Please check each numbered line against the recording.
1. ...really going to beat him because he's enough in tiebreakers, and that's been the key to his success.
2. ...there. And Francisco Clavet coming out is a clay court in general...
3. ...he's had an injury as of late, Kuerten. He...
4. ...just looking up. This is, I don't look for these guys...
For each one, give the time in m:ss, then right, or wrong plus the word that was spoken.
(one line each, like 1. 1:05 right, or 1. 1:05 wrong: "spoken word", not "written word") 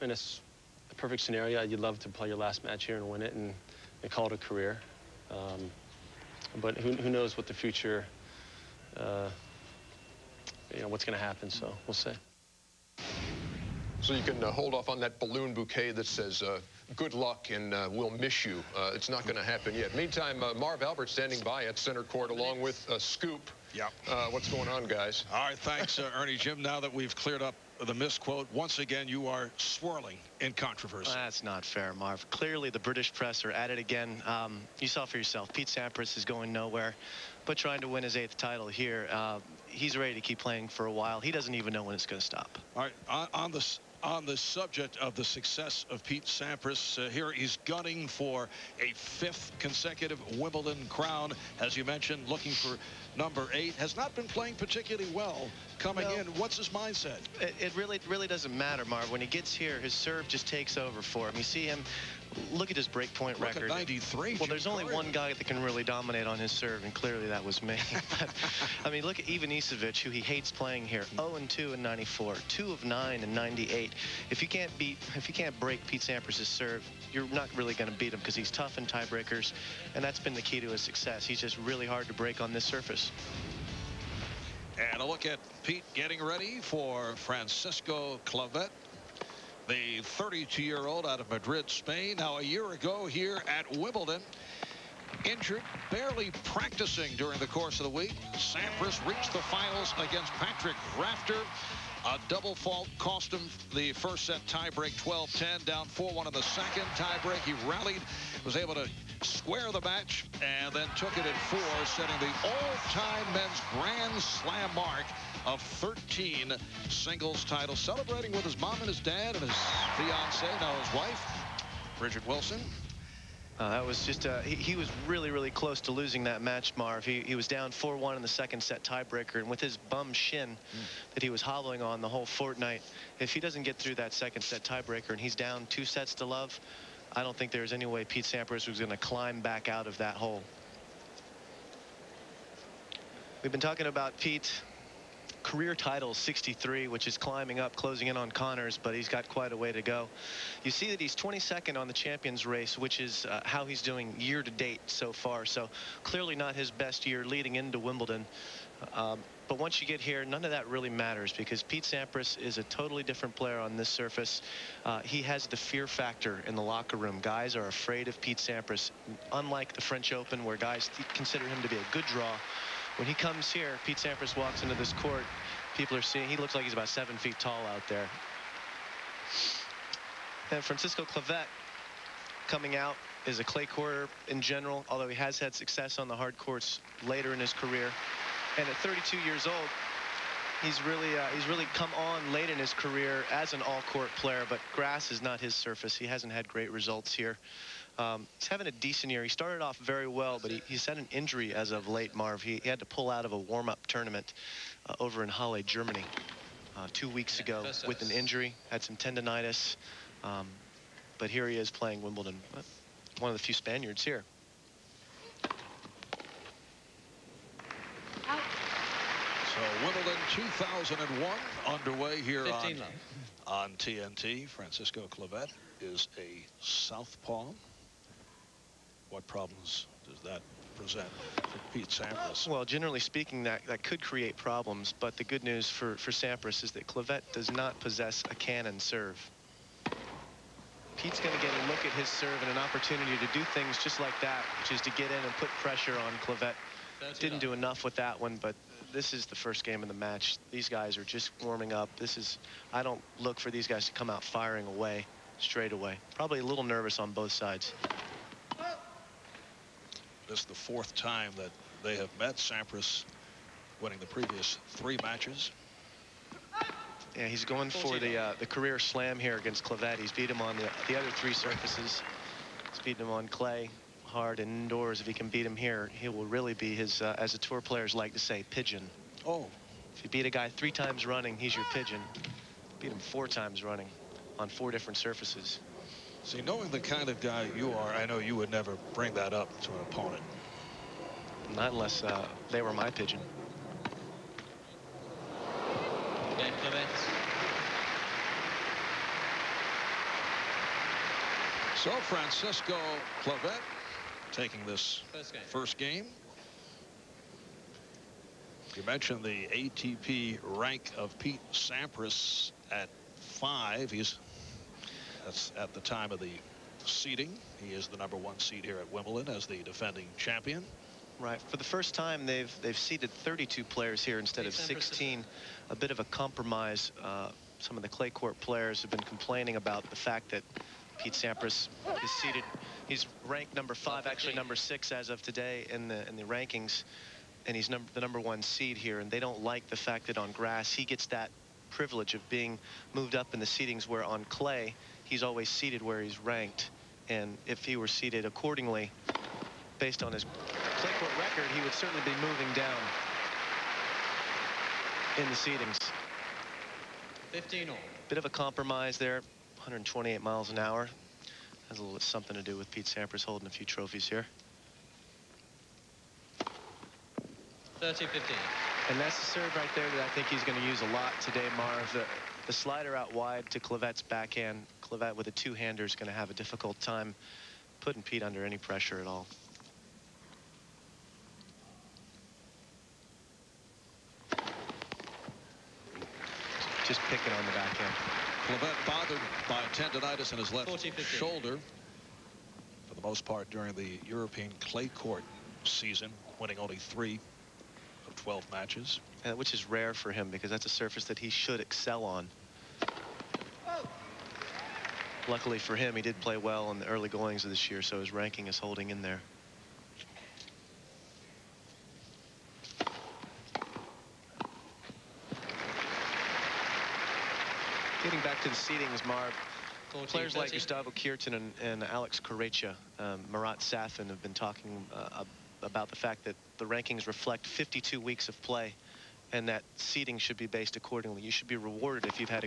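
1. 1:17 wrong: "tough", not "enough"
2. 2:57 right
3. 3:20 wrong: "Marv", not "Kuerten"
4. 4:11 wrong: "warming", not "looking".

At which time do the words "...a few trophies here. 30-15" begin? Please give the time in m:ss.
6:03.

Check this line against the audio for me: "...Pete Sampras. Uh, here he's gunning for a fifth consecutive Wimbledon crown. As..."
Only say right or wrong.
right.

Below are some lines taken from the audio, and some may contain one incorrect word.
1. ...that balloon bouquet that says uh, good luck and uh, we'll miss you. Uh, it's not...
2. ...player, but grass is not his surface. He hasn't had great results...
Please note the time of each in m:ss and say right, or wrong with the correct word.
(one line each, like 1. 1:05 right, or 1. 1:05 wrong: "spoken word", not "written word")
1. 0:14 right
2. 3:14 right.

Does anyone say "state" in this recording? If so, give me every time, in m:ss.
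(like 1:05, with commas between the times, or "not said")
not said.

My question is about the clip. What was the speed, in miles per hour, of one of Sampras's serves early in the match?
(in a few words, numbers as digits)
128.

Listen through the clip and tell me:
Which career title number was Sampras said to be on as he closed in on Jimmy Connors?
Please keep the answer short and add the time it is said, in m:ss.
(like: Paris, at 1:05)
63, at 2:26.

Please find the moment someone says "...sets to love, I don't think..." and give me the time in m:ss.
2:15.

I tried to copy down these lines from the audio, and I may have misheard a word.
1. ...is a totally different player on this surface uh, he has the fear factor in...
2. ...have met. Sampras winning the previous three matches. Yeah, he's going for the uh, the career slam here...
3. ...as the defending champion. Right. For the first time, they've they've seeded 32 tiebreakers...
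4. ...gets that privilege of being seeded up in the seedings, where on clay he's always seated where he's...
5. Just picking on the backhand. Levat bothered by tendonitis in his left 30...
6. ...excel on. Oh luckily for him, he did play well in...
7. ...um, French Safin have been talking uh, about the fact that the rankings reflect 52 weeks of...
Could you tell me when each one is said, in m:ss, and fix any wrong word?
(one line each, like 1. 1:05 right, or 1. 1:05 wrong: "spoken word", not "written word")
1. 2:42 right
2. 4:21 right
3. 5:19 wrong: "players", not "tiebreakers"
4. 5:40 wrong: "moved", not "seeded"
5. 6:26 wrong: "40", not "30"
6. 6:41 right
7. 7:02 wrong: "Marat", not "French".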